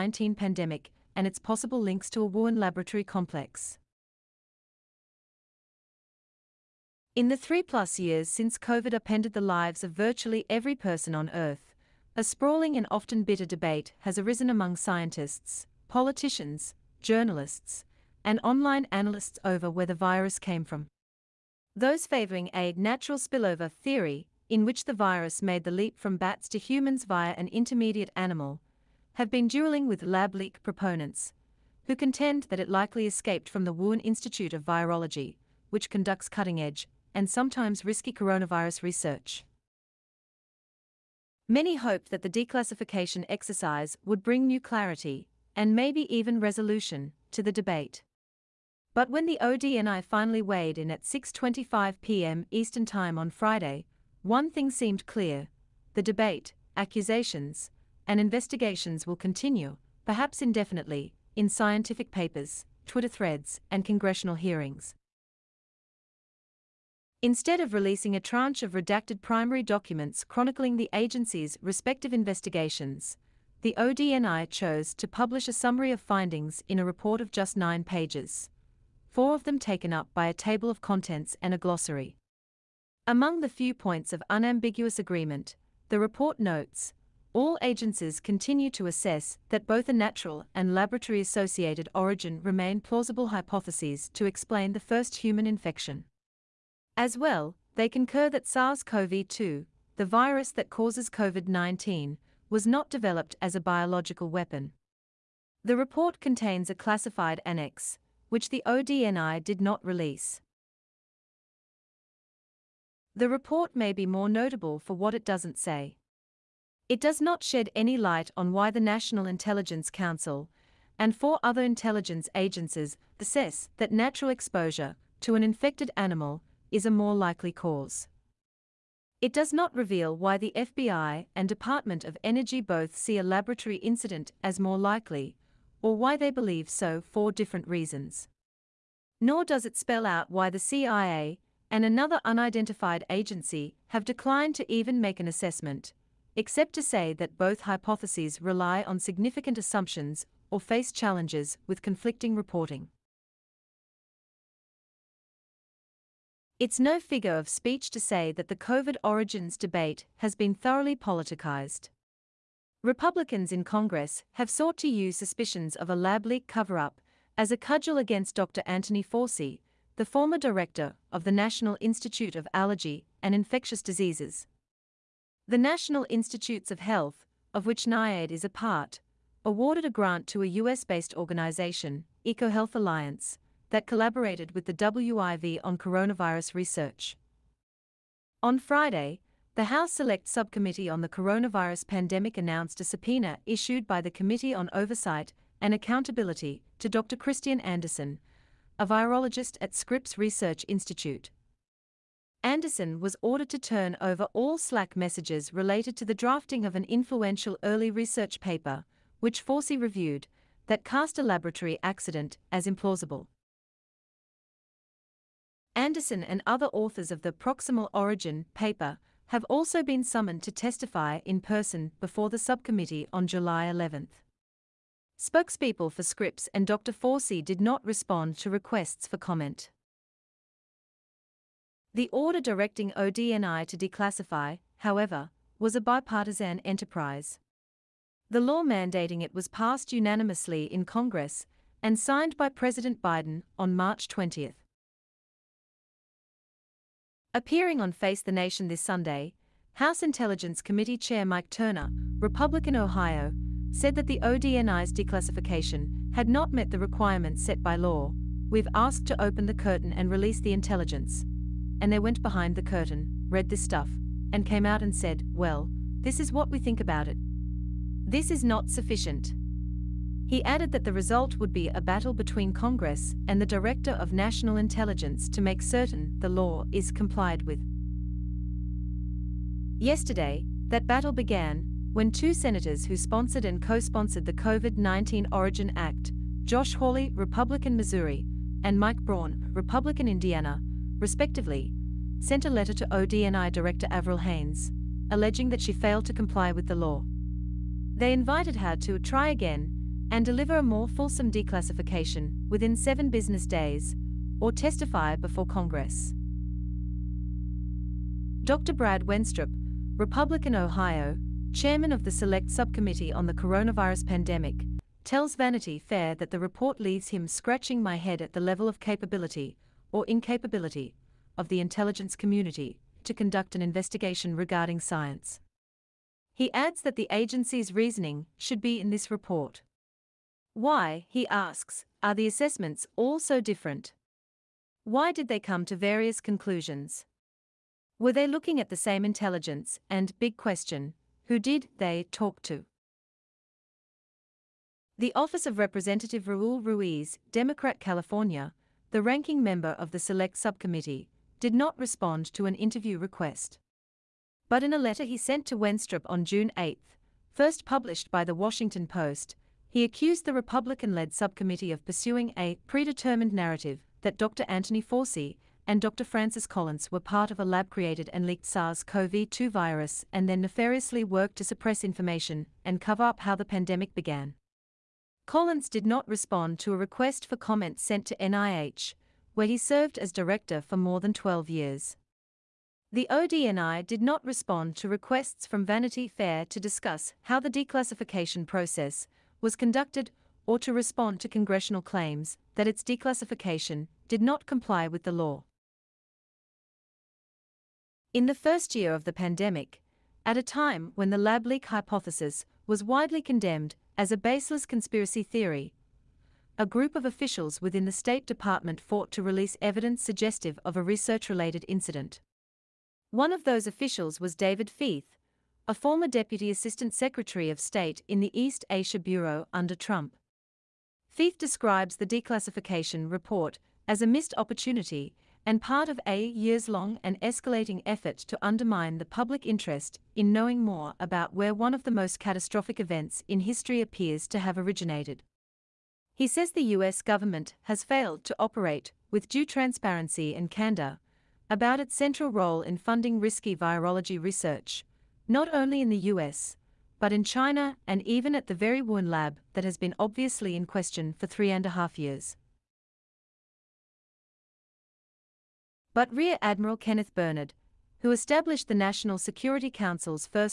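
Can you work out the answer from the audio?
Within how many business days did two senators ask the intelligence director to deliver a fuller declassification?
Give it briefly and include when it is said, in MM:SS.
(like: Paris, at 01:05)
7, at 05:02.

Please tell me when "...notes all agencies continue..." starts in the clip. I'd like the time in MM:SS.
01:26.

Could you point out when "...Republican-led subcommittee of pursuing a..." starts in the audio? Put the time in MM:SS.
06:00.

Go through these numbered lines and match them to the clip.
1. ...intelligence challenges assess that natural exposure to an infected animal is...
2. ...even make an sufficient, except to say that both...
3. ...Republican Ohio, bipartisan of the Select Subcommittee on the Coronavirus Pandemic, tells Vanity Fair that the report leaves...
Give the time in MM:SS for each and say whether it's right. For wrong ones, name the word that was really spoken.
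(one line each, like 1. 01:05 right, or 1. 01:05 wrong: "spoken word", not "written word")
1. 02:01 wrong: "agencies", not "challenges"
2. 02:24 wrong: "assessment", not "sufficient"
3. 05:09 wrong: "chairman", not "bipartisan".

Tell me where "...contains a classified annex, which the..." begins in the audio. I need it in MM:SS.
01:46.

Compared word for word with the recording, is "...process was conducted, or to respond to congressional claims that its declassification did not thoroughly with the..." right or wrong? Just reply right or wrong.
wrong.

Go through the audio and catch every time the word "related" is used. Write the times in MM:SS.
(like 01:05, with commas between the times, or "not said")
03:25, 06:51.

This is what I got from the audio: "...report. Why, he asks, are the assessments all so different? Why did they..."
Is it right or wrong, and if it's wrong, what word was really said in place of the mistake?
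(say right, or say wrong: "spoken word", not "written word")
right.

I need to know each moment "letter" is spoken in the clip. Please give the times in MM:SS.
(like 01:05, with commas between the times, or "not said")
04:52, 05:54.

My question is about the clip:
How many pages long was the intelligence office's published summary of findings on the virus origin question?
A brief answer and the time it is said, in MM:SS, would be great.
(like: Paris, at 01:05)
9, at 01:17.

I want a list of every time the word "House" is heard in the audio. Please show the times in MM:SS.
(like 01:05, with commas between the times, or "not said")
03:09, 04:09.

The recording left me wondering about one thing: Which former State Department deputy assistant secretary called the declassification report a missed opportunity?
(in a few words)
David Feith.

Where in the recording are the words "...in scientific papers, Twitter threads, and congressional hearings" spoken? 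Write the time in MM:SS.
01:01.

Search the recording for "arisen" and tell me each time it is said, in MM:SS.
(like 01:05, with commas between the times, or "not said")
00:14.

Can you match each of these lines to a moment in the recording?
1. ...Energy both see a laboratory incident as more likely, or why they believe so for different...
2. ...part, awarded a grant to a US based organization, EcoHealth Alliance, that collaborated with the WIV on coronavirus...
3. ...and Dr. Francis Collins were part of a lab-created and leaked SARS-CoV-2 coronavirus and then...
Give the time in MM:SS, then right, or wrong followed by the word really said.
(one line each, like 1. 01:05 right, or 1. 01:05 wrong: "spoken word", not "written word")
1. 02:12 right
2. 02:58 right
3. 06:05 wrong: "virus", not "coronavirus".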